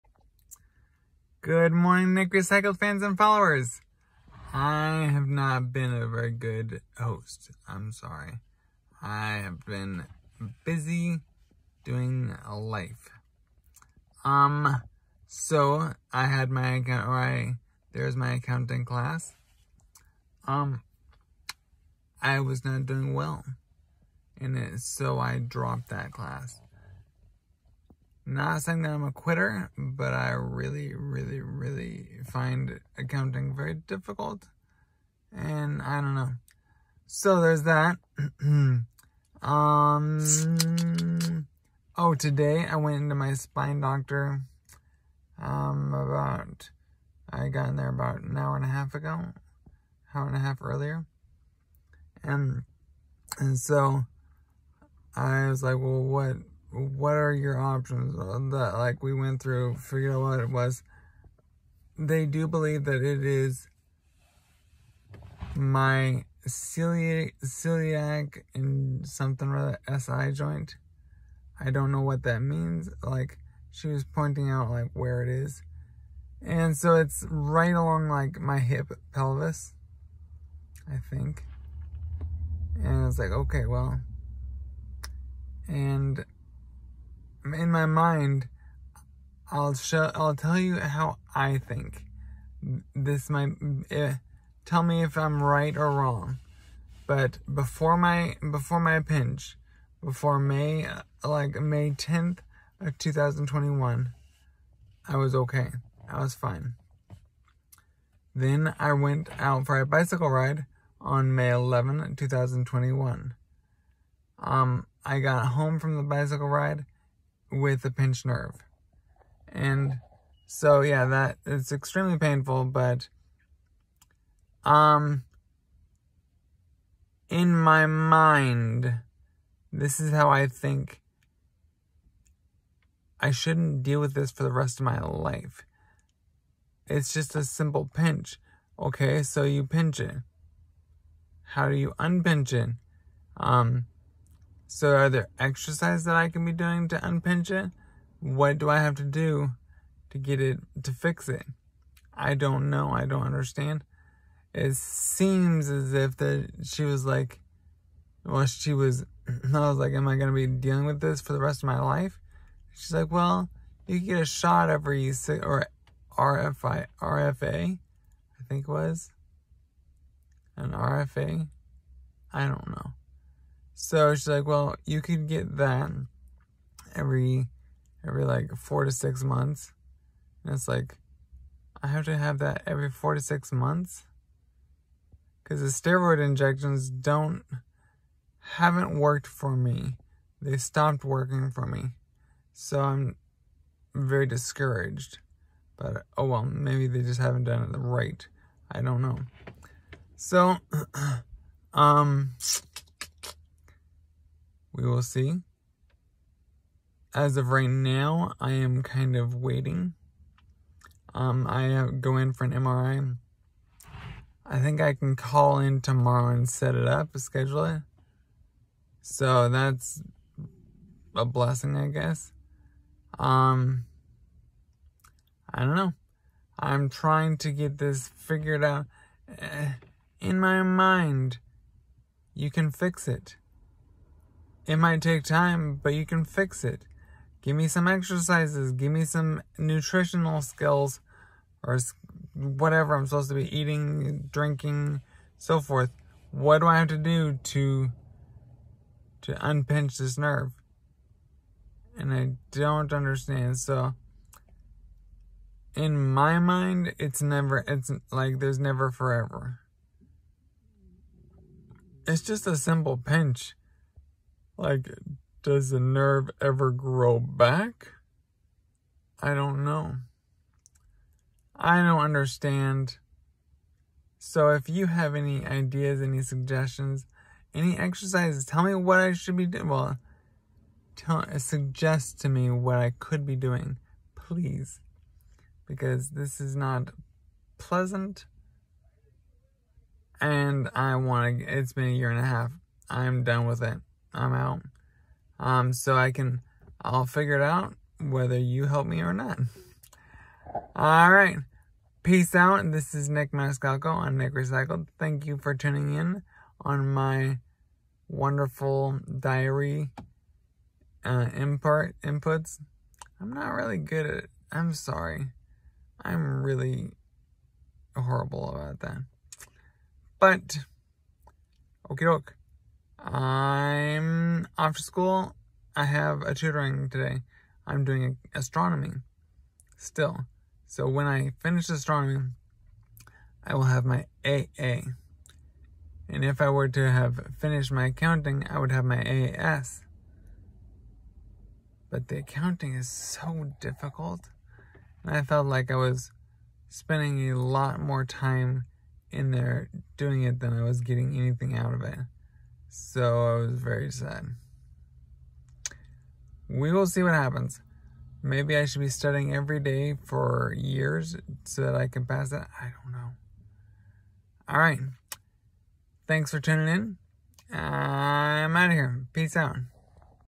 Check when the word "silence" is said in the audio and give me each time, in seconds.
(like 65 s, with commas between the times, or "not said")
not said.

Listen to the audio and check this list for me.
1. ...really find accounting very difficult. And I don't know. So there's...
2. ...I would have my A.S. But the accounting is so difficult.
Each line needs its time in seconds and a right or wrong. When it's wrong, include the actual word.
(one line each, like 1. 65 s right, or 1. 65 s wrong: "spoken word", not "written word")
1. 31 s right
2. 338 s right.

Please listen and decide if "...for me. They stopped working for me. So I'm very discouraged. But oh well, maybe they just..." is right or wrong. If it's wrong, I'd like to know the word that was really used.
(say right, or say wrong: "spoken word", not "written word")
right.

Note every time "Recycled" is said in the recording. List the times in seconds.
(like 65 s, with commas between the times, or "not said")
2 s, 304 s.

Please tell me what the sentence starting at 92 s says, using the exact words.
This might, eh, tell me if I'm right or wrong.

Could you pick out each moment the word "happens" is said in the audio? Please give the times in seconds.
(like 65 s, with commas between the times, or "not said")
357 s.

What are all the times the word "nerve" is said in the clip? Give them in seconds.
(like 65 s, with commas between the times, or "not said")
118 s, 250 s, 265 s.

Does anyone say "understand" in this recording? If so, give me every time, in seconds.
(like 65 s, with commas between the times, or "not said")
153 s, 252 s, 272 s.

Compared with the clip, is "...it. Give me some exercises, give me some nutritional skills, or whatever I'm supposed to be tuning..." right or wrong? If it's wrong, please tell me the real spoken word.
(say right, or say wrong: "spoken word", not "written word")
wrong: "eating", not "tuning".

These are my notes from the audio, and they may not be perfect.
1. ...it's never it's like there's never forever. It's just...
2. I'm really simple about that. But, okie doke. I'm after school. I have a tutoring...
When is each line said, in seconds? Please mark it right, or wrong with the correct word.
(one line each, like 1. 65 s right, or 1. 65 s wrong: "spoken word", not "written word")
1. 256 s right
2. 316 s wrong: "horrible", not "simple".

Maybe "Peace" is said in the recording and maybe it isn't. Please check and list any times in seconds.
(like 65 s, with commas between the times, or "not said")
302 s, 369 s.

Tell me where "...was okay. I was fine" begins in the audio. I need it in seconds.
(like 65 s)
105 s.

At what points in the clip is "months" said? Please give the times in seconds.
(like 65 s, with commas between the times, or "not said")
179 s, 183 s.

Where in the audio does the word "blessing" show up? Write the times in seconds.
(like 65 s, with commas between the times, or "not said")
221 s.